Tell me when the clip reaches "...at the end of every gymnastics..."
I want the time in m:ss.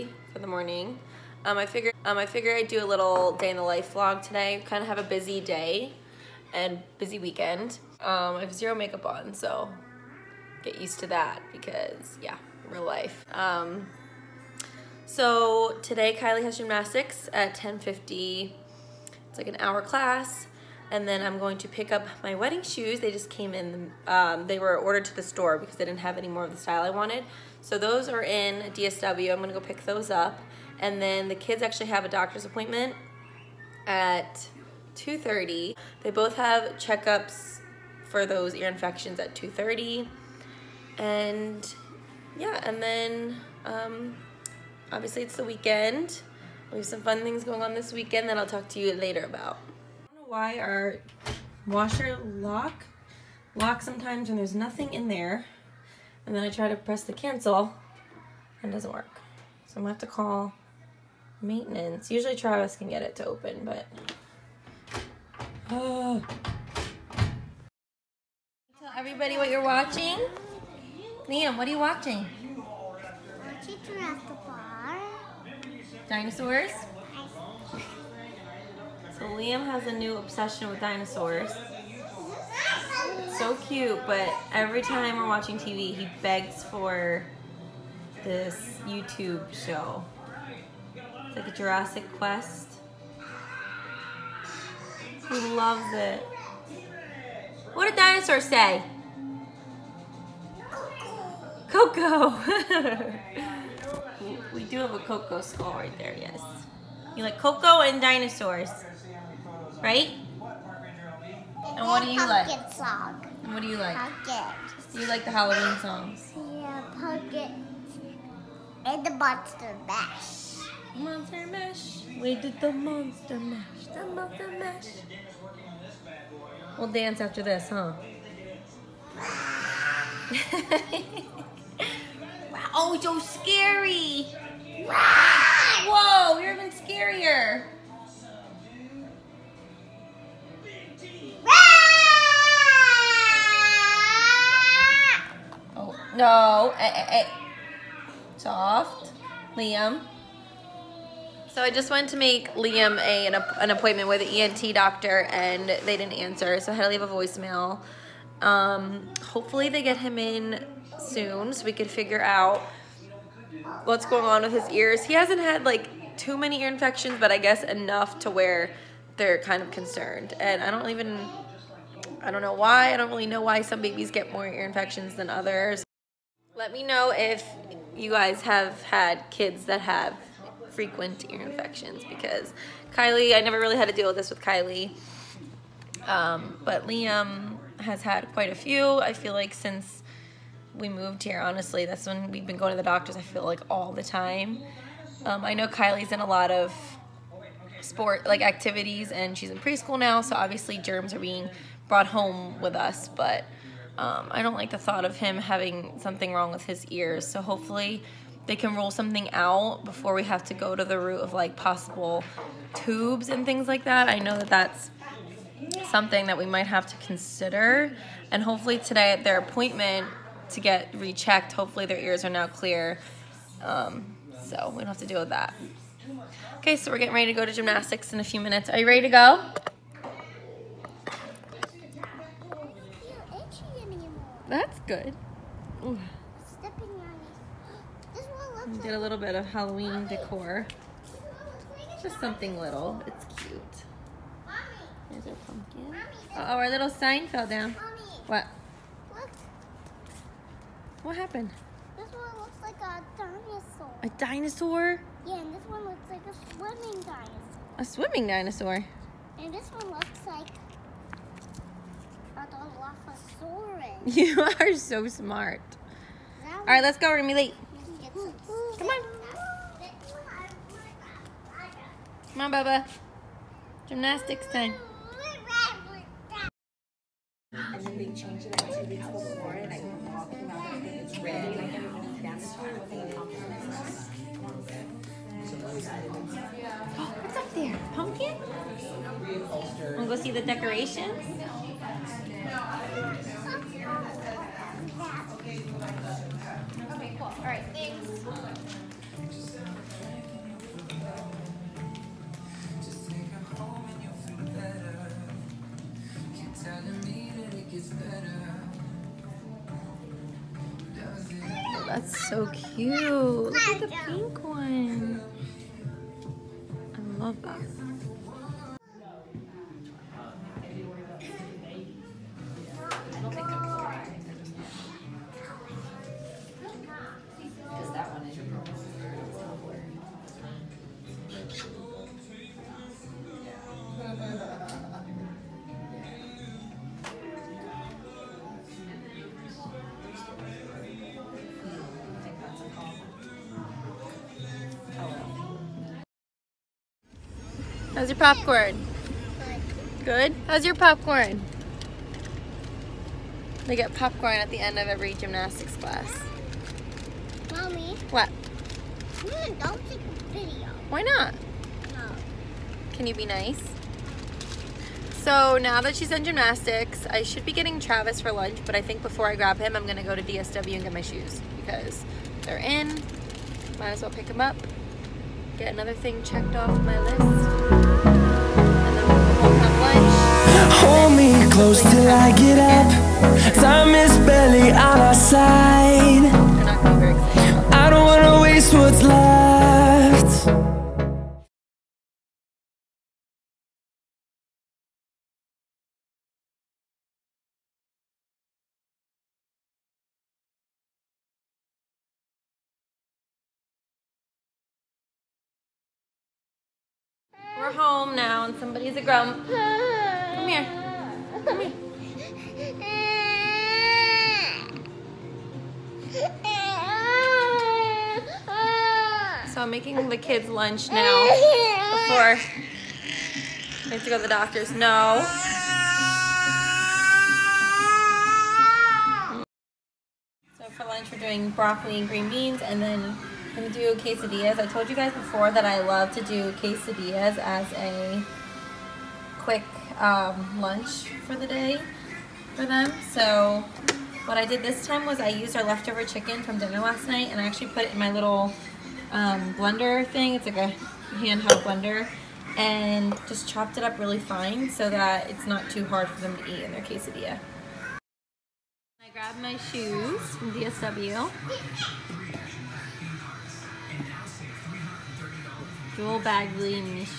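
5:54.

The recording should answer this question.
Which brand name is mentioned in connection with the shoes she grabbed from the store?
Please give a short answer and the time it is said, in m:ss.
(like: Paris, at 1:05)
Jewel Badgley, at 7:45.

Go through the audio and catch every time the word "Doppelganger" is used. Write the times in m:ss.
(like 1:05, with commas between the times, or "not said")
not said.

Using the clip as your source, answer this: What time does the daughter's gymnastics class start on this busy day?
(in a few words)
10:50.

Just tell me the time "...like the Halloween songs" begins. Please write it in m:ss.
1:55.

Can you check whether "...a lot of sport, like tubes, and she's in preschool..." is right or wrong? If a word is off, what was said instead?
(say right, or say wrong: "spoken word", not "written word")
wrong: "activities", not "tubes".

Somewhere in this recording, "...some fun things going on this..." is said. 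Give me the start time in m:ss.
0:46.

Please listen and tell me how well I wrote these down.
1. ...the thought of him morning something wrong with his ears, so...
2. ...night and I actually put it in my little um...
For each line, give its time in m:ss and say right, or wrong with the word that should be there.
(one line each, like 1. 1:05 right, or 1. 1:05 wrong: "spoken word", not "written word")
1. 3:24 wrong: "having", not "morning"
2. 7:27 right.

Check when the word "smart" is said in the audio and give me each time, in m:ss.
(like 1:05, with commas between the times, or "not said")
4:25.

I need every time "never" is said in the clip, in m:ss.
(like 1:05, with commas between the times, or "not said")
3:03.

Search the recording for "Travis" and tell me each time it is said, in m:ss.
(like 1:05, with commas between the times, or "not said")
1:02, 6:07.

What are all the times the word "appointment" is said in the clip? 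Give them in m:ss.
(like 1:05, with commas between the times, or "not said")
0:32, 2:33, 3:39.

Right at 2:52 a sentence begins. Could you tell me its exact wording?
I don't really know why some babies get more ear infections than others.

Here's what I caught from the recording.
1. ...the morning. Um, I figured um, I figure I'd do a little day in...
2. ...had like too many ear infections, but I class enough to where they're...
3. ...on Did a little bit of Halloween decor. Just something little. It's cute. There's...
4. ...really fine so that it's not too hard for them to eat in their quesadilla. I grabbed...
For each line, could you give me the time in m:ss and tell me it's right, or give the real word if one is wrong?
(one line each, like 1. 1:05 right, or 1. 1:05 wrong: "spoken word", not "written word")
1. 0:00 right
2. 2:45 wrong: "guess", not "class"
3. 3:58 right
4. 7:33 right.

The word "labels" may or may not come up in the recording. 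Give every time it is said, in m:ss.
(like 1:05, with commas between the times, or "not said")
not said.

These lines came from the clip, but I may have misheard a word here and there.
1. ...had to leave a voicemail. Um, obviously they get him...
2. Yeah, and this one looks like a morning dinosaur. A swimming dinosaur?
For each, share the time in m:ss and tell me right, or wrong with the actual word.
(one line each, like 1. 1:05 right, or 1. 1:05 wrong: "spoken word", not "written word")
1. 2:36 wrong: "hopefully", not "obviously"
2. 4:15 wrong: "swimming", not "morning".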